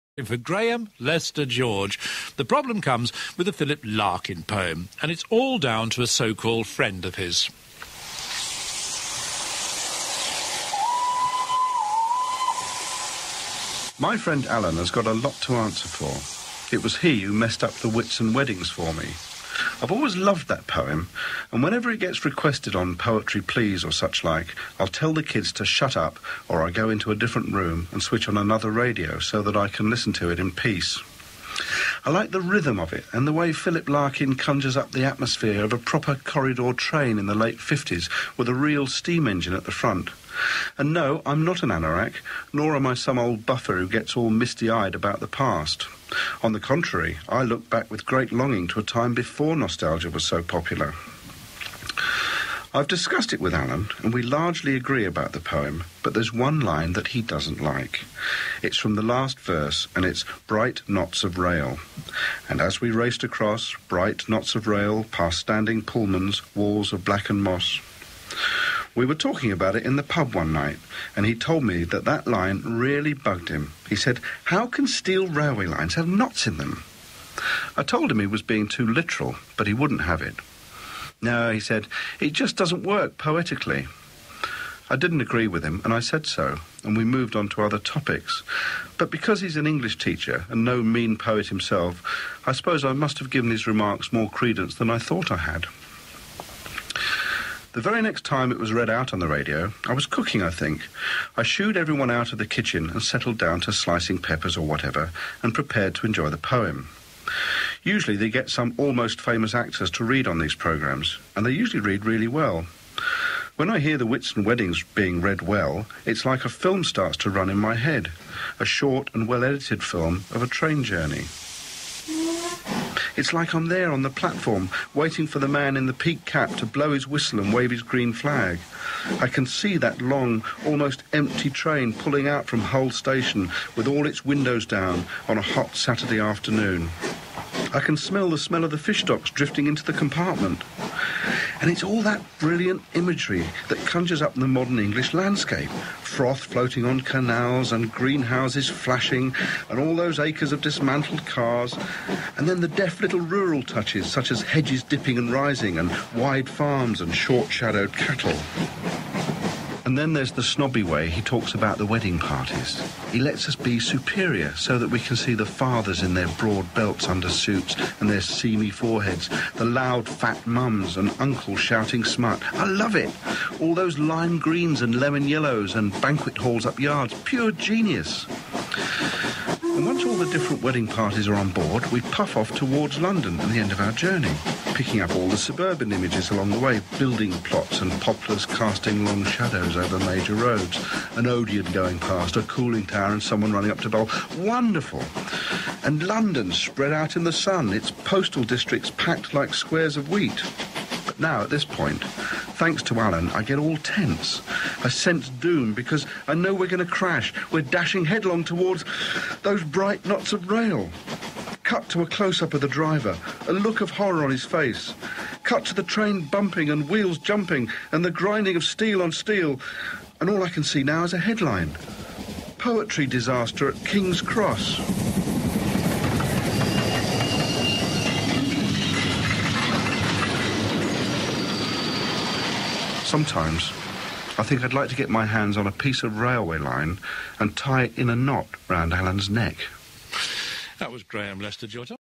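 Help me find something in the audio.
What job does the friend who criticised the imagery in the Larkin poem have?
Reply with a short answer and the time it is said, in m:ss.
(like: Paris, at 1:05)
English teacher, at 1:29.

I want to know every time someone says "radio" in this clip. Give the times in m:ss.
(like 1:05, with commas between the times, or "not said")
0:28, 1:39.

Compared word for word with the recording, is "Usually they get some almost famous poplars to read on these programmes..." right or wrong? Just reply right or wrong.
wrong.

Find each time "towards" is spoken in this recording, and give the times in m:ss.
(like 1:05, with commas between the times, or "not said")
3:02, 3:28.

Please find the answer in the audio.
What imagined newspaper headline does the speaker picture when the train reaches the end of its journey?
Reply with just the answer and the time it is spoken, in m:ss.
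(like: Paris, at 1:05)
Poetry disaster at King's Cross, at 3:42.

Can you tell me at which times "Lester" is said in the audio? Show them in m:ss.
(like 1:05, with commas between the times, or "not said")
0:00, 4:01.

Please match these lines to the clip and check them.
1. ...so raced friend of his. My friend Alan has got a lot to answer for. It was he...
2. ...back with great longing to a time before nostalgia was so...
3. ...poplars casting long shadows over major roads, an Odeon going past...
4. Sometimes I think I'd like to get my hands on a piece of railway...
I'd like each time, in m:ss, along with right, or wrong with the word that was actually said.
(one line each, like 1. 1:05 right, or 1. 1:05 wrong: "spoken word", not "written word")
1. 0:06 wrong: "called", not "raced"
2. 0:47 right
3. 3:08 right
4. 3:53 right.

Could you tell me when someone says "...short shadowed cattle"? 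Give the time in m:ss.
2:37.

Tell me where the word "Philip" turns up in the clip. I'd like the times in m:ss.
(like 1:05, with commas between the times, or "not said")
0:03, 0:33.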